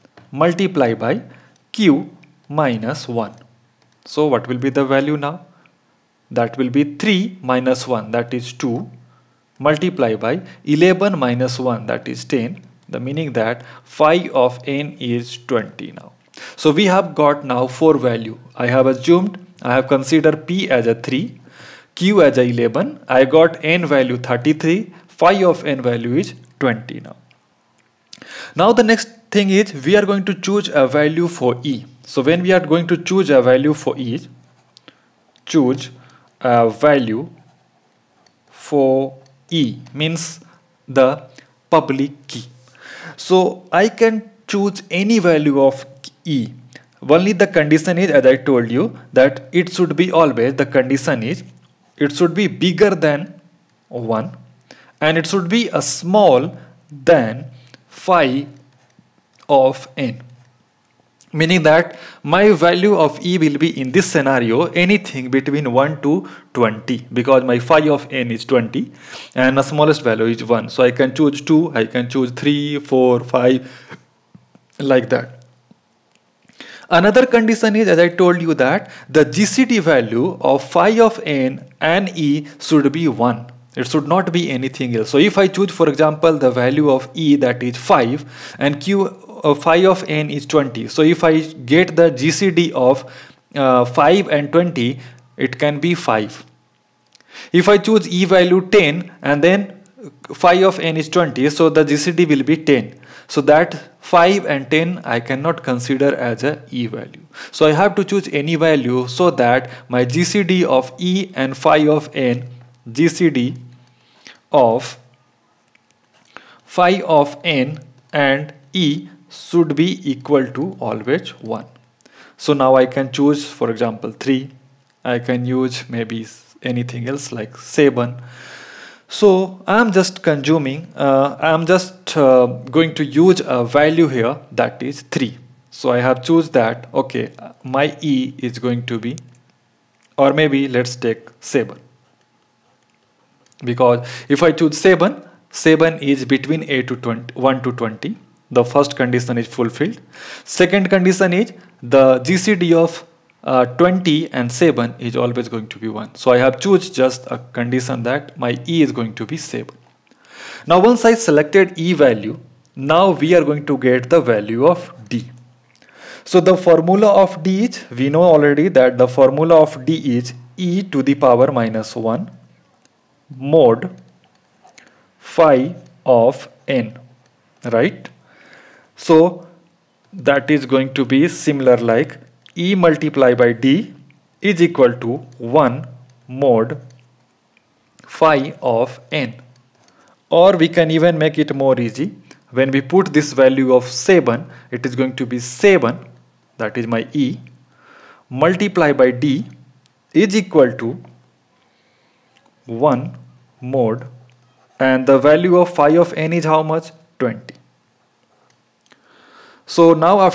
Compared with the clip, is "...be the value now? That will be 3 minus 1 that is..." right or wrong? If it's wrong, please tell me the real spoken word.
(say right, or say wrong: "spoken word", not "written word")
right.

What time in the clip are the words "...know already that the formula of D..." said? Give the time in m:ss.
2:48.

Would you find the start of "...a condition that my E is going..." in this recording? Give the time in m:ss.
2:37.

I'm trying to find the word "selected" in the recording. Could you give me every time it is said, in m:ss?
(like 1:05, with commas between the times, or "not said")
2:41.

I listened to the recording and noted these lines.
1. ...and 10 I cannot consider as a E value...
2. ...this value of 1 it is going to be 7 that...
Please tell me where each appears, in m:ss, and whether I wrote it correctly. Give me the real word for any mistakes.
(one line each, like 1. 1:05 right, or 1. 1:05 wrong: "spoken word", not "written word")
1. 1:44 right
2. 3:13 wrong: "7", not "1".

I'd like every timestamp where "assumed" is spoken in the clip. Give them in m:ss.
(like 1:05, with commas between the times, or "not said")
0:18.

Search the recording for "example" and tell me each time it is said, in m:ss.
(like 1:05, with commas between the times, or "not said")
1:25, 2:03.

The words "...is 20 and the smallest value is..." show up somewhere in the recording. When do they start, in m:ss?
1:08.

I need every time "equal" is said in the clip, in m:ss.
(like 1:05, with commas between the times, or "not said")
2:00, 3:04, 3:20.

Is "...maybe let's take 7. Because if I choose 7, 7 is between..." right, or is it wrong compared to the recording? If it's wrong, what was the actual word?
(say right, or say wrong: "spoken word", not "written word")
right.